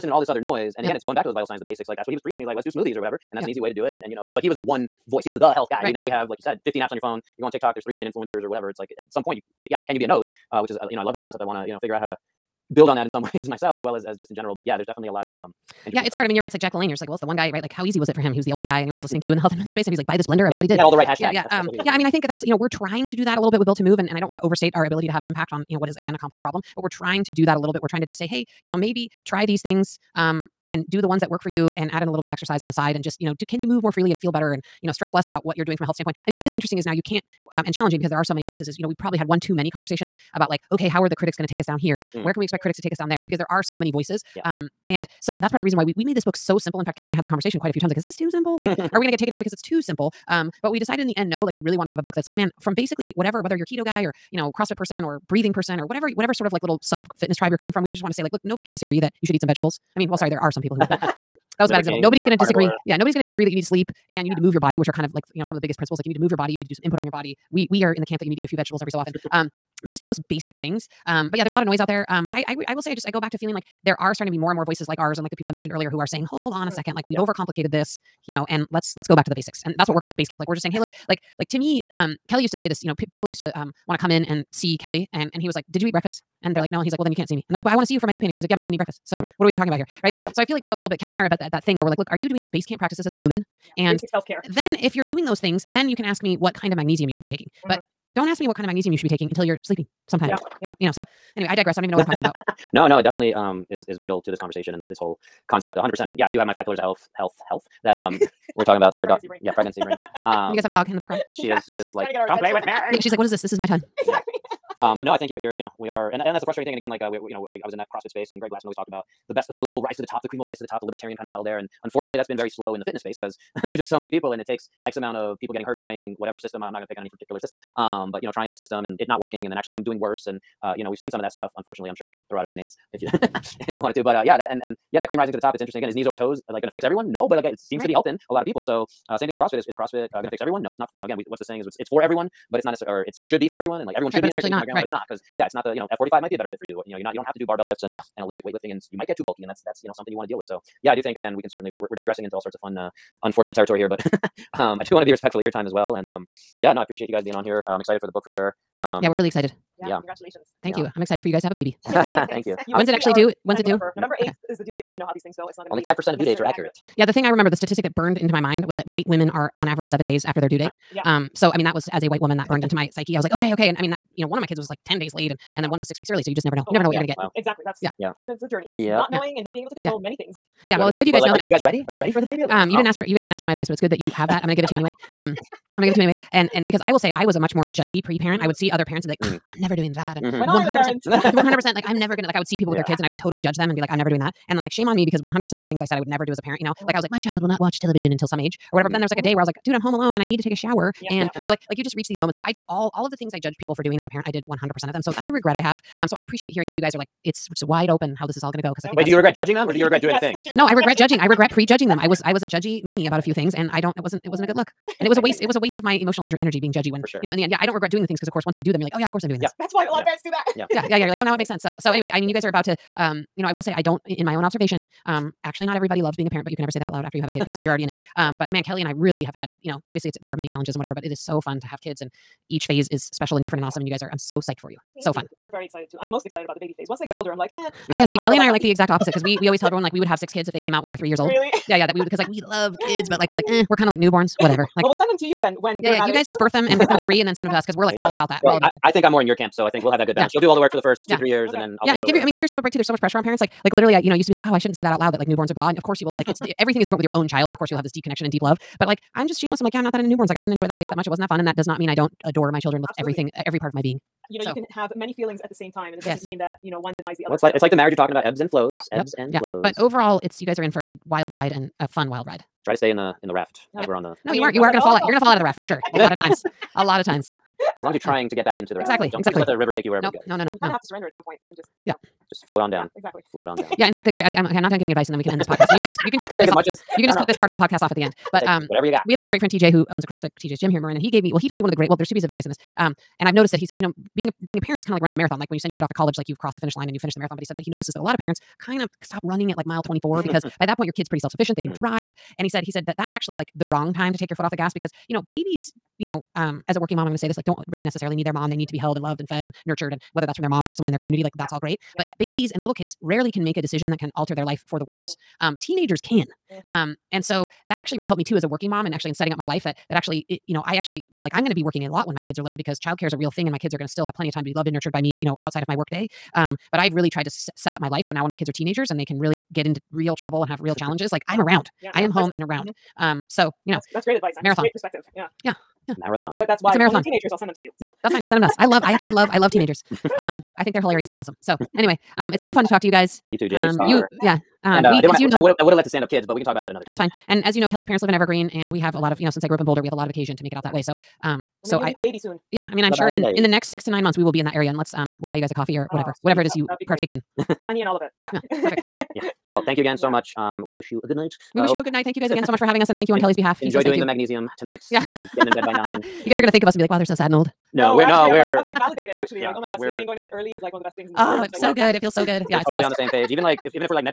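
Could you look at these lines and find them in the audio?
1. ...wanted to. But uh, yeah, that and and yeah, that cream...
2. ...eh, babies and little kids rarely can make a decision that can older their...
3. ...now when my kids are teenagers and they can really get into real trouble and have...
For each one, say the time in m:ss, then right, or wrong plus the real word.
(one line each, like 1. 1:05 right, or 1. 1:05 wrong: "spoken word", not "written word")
1. 2:13 right
2. 5:12 wrong: "alter", not "older"
3. 5:28 right.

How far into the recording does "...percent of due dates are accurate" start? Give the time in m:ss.
2:45.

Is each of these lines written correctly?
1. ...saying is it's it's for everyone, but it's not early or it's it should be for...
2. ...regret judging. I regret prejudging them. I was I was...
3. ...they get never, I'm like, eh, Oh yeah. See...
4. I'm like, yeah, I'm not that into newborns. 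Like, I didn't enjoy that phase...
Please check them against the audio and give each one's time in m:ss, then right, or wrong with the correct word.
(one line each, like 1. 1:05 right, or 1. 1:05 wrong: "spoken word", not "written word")
1. 2:21 wrong: "necessarily", not "early"
2. 3:30 right
3. 3:56 wrong: "older", not "never"
4. 4:19 right.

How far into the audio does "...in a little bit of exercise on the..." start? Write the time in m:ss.
0:32.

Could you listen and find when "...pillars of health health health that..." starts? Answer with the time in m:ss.
1:46.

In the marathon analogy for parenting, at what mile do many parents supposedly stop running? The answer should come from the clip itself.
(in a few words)
mile 24.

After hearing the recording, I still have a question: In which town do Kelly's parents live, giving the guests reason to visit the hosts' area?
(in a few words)
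Evergreen.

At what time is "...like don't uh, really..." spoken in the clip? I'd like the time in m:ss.
5:07.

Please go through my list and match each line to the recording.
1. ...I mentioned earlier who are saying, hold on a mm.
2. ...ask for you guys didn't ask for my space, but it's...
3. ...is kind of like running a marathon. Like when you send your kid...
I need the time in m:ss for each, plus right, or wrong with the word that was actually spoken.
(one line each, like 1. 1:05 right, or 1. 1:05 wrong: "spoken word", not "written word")
1. 1:15 right
2. 3:02 wrong: "advice", not "space"
3. 4:54 right.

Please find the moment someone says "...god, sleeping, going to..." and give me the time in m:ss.
6:09.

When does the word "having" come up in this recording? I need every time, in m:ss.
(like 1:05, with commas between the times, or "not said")
6:02.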